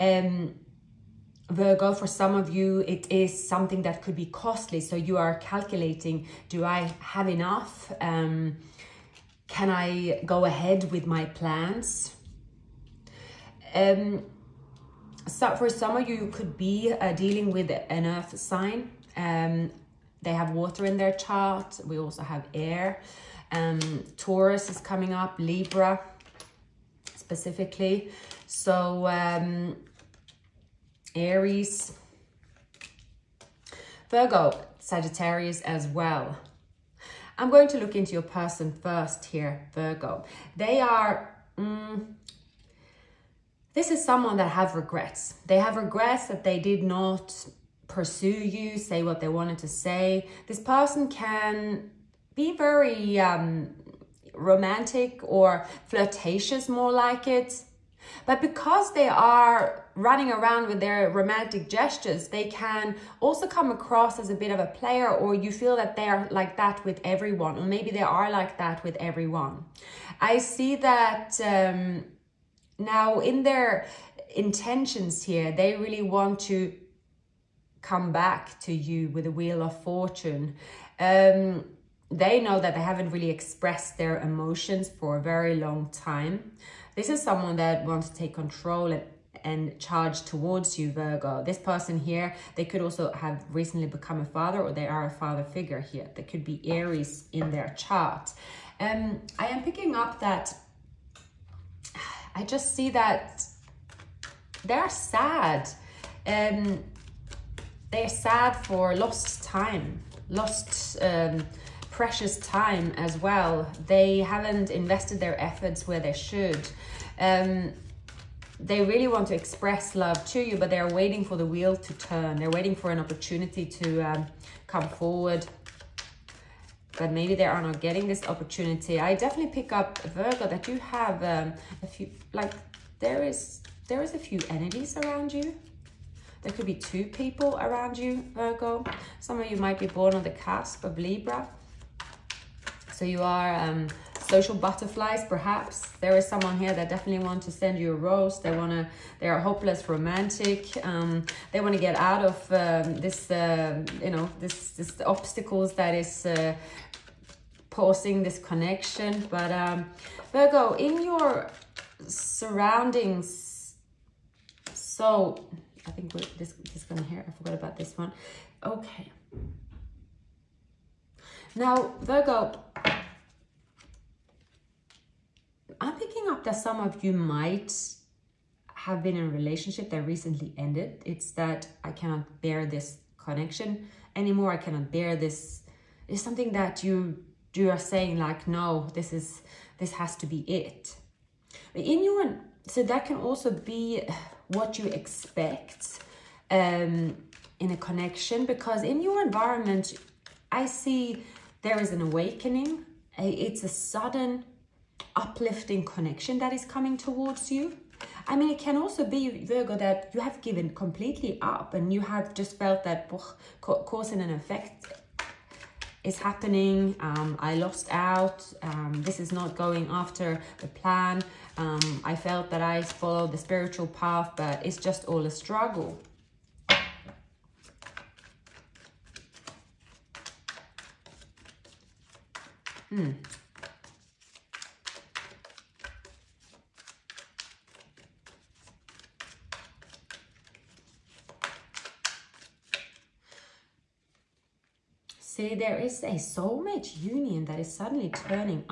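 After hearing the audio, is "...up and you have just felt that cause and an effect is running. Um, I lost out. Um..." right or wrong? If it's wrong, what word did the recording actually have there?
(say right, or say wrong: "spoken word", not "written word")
wrong: "happening", not "running".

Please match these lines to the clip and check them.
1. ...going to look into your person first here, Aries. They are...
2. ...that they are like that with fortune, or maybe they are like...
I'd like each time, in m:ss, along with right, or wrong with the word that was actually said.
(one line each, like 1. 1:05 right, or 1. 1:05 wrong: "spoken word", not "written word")
1. 0:37 wrong: "Virgo", not "Aries"
2. 1:05 wrong: "everyone", not "fortune".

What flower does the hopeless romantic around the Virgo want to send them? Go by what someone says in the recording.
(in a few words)
A rose.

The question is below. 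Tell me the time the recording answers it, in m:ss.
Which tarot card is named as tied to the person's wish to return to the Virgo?
1:19.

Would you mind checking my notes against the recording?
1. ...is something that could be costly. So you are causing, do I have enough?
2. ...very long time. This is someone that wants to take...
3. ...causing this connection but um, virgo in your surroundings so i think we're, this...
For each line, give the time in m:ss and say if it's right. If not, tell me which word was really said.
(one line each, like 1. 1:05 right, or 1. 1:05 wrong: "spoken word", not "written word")
1. 0:03 wrong: "calculating", not "causing"
2. 1:25 right
3. 2:37 right.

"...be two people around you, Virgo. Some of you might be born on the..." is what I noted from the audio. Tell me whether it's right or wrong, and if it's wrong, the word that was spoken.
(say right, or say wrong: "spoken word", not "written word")
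right.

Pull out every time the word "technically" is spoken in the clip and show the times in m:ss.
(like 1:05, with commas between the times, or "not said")
not said.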